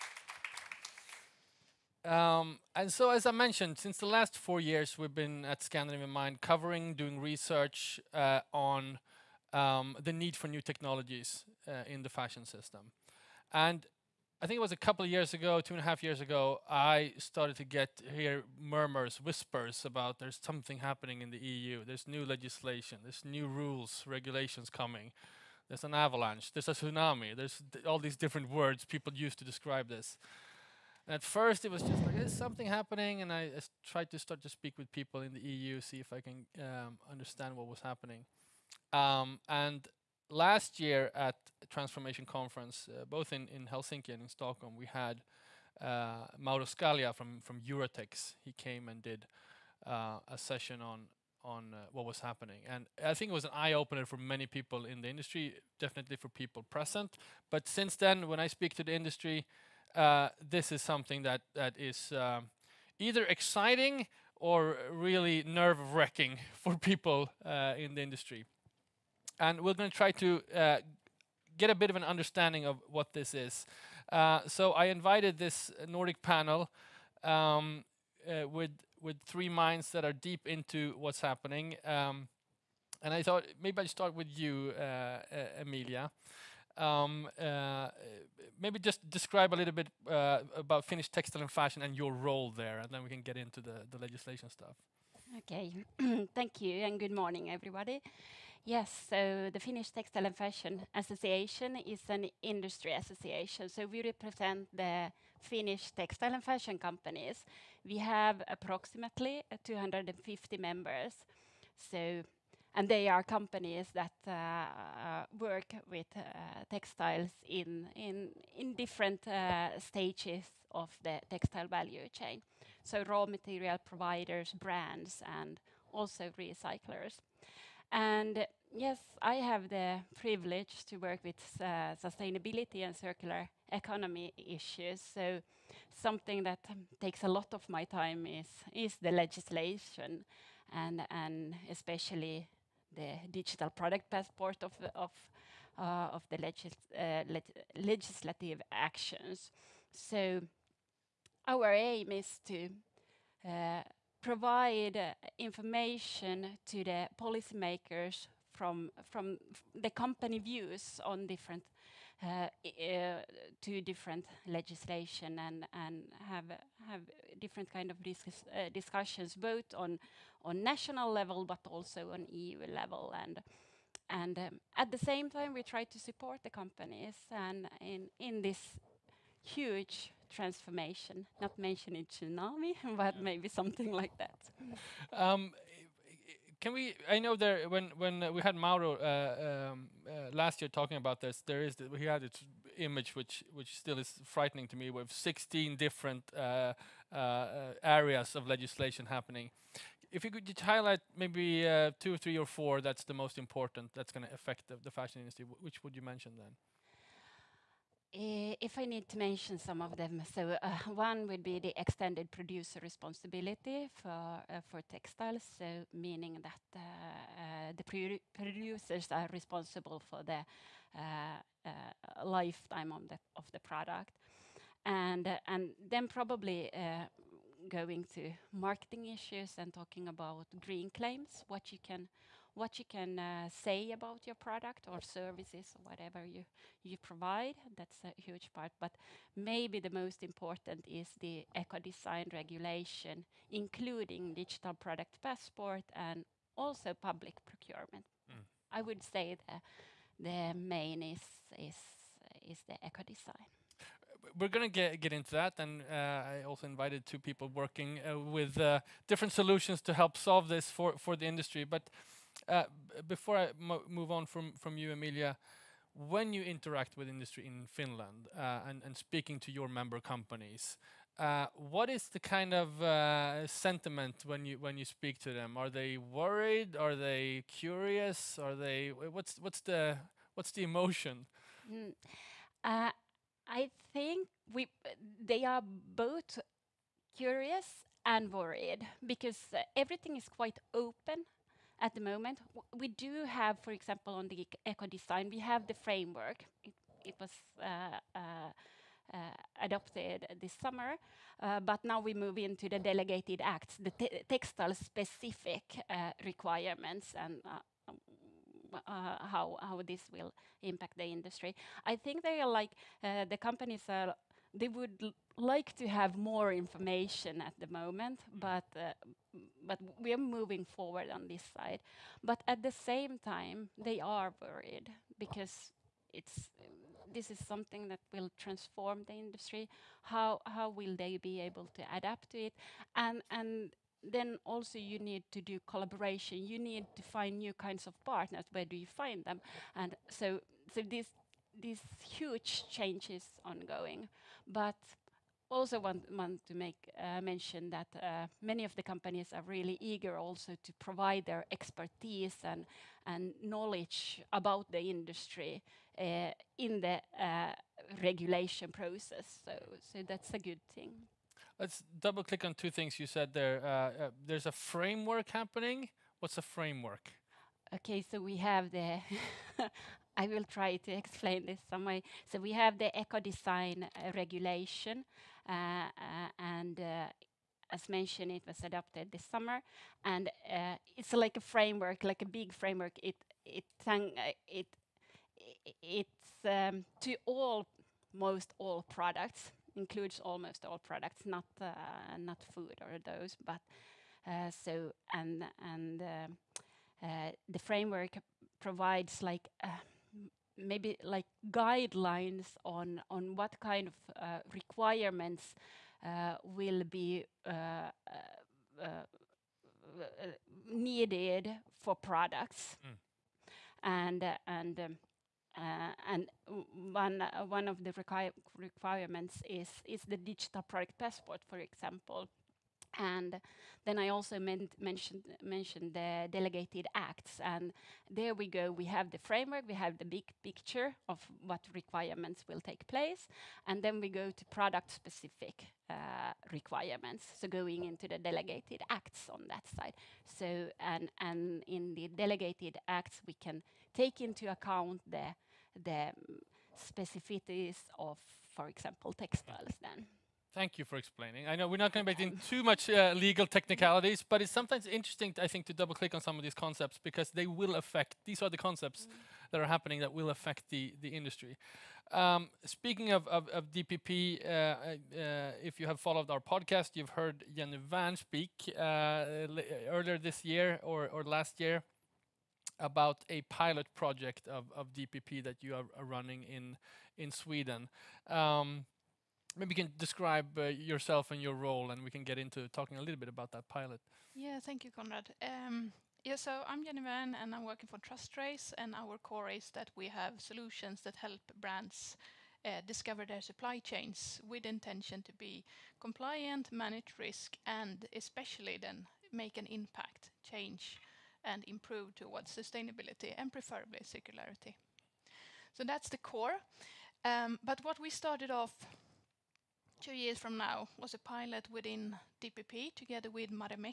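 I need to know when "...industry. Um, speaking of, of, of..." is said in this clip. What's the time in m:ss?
7:41.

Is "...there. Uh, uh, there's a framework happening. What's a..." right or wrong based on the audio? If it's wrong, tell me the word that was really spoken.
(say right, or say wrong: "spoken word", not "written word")
right.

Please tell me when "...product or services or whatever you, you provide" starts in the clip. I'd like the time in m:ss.
3:54.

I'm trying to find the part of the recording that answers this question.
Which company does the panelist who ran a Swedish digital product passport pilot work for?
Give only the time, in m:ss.
8:07.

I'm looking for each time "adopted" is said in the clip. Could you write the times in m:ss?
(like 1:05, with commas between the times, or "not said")
4:59, 6:18.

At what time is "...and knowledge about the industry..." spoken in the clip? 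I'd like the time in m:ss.
5:53.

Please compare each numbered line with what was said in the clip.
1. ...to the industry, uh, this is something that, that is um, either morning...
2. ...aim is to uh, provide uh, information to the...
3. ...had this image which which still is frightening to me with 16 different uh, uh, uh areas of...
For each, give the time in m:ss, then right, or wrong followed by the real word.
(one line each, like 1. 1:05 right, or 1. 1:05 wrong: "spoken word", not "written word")
1. 0:58 wrong: "exciting", not "morning"
2. 2:31 right
3. 3:12 right.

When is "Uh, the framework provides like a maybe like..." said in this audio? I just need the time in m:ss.
6:37.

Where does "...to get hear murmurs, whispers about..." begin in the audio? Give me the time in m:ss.
0:17.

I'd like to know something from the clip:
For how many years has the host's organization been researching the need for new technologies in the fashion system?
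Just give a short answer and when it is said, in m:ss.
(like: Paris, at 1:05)
4 years, at 0:04.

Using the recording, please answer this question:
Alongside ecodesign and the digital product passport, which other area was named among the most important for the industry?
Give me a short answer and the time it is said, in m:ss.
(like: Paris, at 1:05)
Public procurement, at 4:06.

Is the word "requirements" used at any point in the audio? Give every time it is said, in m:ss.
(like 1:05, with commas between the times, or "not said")
5:06, 6:44, 6:58, 7:11, 7:16.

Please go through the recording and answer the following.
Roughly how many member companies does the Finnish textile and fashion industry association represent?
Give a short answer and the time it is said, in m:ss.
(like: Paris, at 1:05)
250, at 1:49.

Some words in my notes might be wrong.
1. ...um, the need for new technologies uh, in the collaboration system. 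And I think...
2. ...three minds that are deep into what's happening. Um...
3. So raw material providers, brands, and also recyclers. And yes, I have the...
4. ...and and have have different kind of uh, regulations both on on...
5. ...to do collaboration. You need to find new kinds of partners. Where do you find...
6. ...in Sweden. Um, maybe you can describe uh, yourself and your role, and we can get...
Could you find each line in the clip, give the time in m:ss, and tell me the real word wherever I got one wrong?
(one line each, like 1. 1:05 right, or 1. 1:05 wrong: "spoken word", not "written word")
1. 0:09 wrong: "fashion", not "collaboration"
2. 1:19 right
3. 2:02 right
4. 2:45 wrong: "discussions", not "regulations"
5. 5:35 right
6. 7:57 right.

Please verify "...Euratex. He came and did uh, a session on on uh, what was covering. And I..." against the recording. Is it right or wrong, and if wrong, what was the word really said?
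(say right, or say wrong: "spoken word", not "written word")
wrong: "happening", not "covering".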